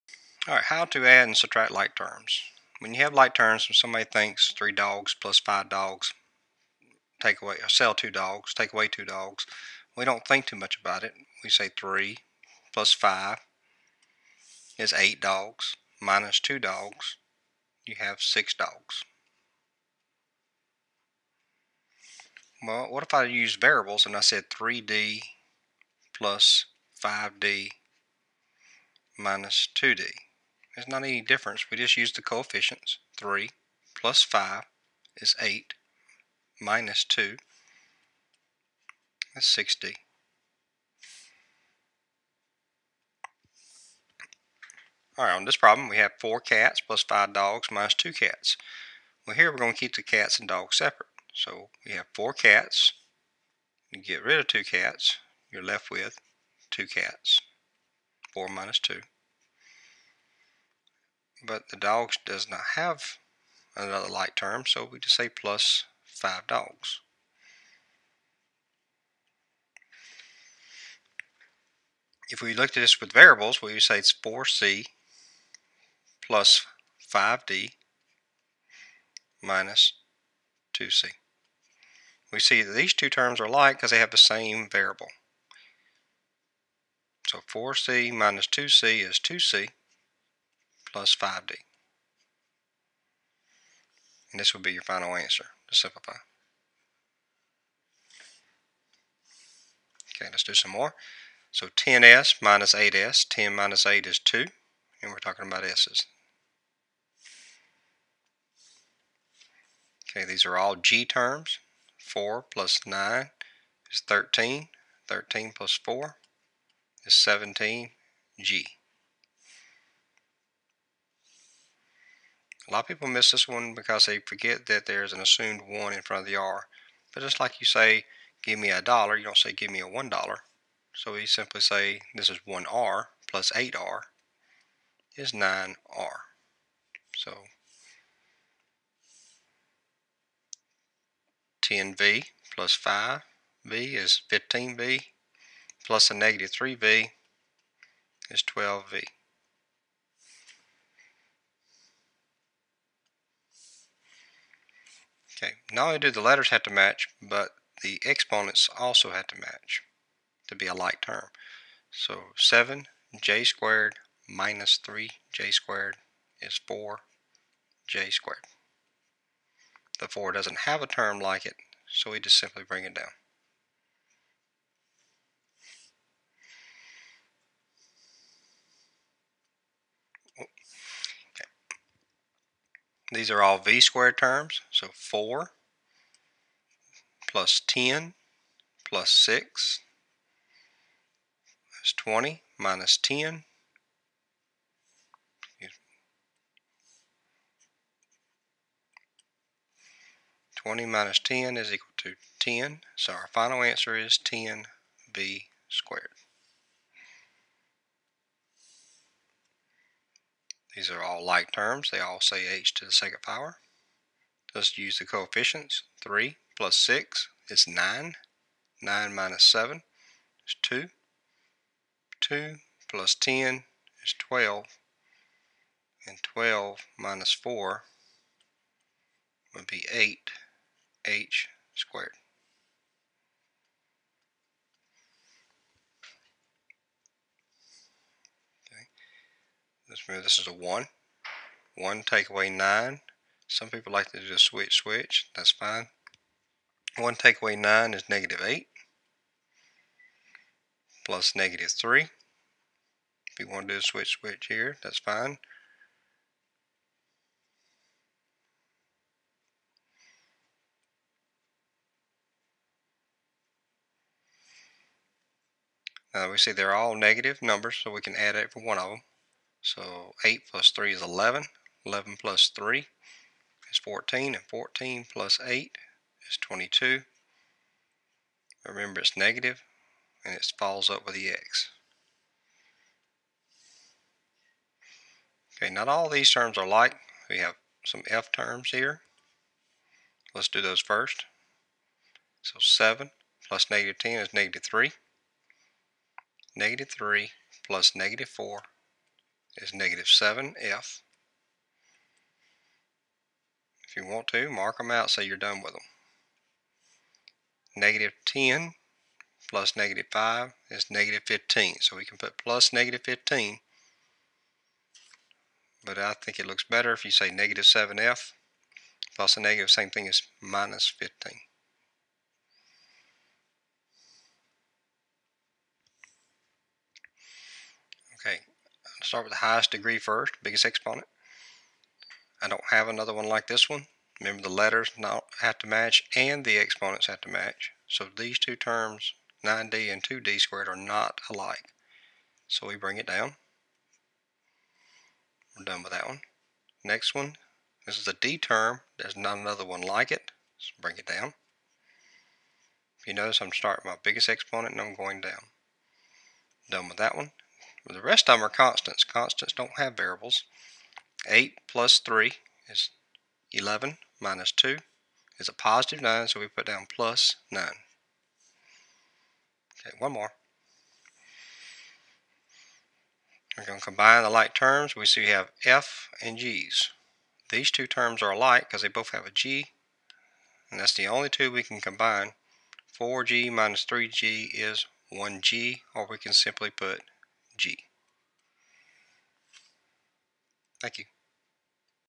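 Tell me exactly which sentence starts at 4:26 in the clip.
Now we see they're all negative numbers, so we can add it for one of them.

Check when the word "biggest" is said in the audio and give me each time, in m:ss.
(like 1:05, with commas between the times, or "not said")
5:30, 5:54.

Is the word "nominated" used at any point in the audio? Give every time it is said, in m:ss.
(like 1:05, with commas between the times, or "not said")
not said.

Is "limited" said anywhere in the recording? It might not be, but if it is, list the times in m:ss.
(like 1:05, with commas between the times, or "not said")
not said.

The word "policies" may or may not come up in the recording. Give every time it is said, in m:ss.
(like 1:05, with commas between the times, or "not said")
not said.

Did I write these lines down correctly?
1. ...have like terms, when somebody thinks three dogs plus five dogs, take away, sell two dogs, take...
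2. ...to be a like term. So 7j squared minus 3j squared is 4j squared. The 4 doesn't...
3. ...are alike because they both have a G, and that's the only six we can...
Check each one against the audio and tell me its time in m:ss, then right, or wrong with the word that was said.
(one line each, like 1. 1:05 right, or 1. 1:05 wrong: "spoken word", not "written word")
1. 0:03 right
2. 2:40 right
3. 6:18 wrong: "two", not "six".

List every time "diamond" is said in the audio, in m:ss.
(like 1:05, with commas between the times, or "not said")
not said.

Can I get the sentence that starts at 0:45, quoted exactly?
Alright, on this problem we have 4 cats plus 5 dogs minus 2 cats.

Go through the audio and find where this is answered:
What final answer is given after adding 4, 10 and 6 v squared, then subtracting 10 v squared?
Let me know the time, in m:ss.
3:24.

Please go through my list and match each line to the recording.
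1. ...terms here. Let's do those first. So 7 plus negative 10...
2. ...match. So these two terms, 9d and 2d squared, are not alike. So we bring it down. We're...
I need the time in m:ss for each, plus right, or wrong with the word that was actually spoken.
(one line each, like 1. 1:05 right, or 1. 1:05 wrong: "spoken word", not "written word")
1. 4:48 right
2. 5:37 right.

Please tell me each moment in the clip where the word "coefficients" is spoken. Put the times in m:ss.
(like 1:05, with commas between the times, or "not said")
0:32, 3:35.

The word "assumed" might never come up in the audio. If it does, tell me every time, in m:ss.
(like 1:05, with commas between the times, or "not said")
2:05.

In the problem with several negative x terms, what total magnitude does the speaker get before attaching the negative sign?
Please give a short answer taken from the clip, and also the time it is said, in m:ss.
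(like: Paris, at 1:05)
22, at 4:36.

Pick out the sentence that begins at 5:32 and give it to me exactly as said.
I don't have another one like this one.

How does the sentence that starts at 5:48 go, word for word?
There's not another one like it.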